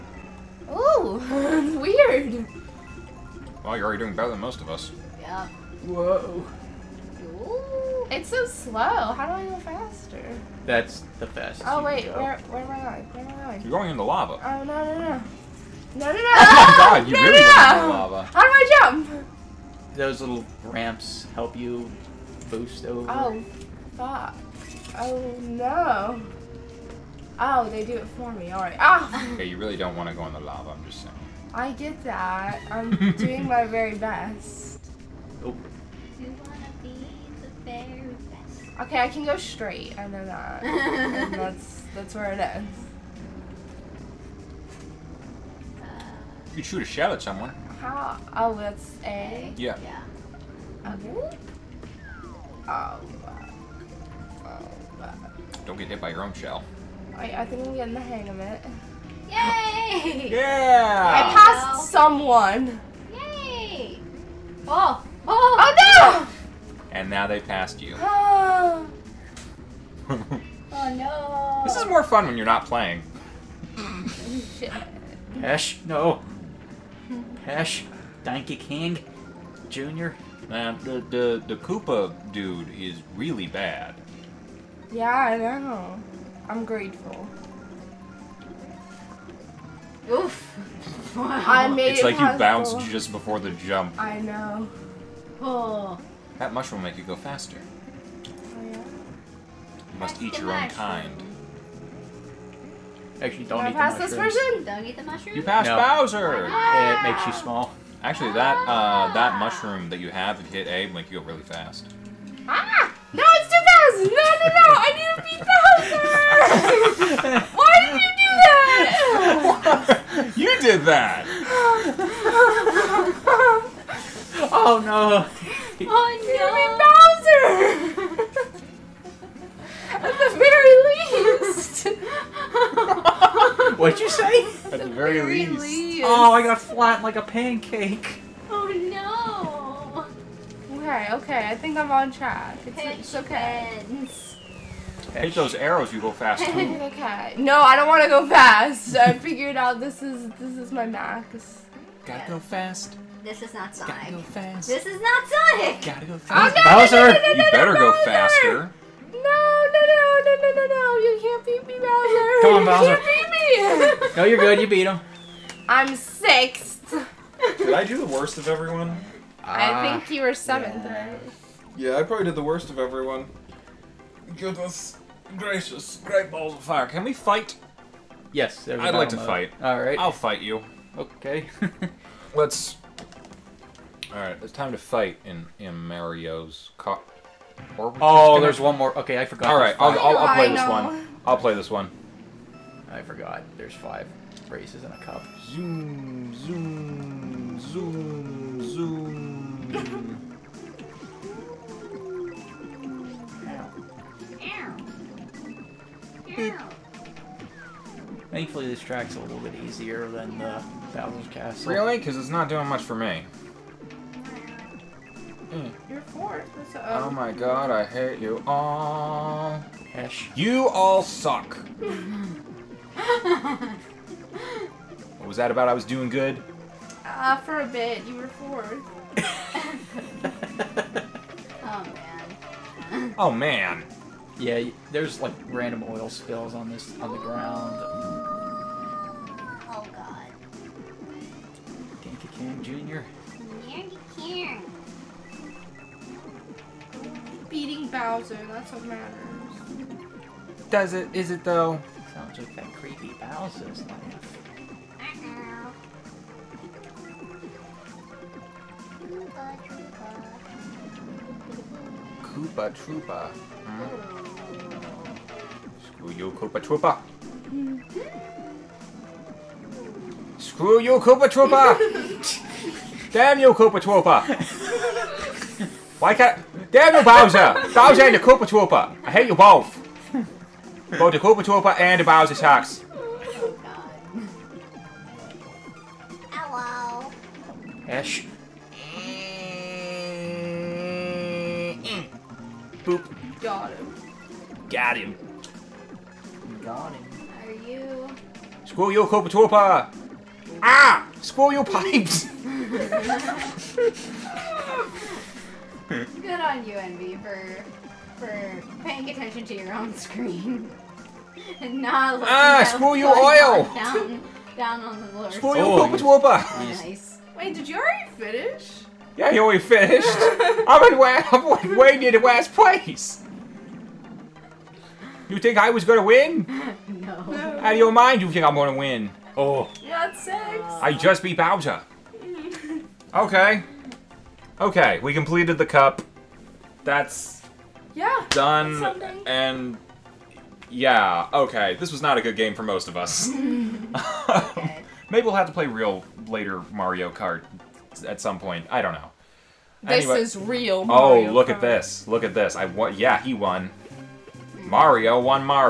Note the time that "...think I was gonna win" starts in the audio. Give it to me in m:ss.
5:25.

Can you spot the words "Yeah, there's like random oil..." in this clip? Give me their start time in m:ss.
3:54.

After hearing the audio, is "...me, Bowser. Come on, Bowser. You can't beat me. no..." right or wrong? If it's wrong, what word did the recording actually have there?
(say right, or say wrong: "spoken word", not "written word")
right.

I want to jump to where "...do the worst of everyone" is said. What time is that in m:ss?
2:47.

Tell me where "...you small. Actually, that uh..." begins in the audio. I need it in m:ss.
1:47.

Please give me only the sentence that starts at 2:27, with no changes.
No, I don't want to go fast.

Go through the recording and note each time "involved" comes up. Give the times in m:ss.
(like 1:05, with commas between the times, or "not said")
not said.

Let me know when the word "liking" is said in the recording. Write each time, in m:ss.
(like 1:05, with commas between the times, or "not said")
not said.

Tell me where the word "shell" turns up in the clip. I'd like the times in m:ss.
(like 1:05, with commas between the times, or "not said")
0:46, 0:56.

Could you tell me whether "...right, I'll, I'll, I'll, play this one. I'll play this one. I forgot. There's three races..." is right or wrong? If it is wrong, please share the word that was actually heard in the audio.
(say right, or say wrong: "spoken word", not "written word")
wrong: "five", not "three".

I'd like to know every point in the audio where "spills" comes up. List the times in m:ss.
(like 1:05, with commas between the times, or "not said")
3:56.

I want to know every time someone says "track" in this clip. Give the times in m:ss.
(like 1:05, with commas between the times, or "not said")
2:22, 3:28.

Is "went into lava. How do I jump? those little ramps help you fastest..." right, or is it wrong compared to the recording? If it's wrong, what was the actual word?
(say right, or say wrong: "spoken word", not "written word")
wrong: "boost", not "fastest".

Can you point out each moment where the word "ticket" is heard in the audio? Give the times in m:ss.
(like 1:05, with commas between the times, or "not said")
not said.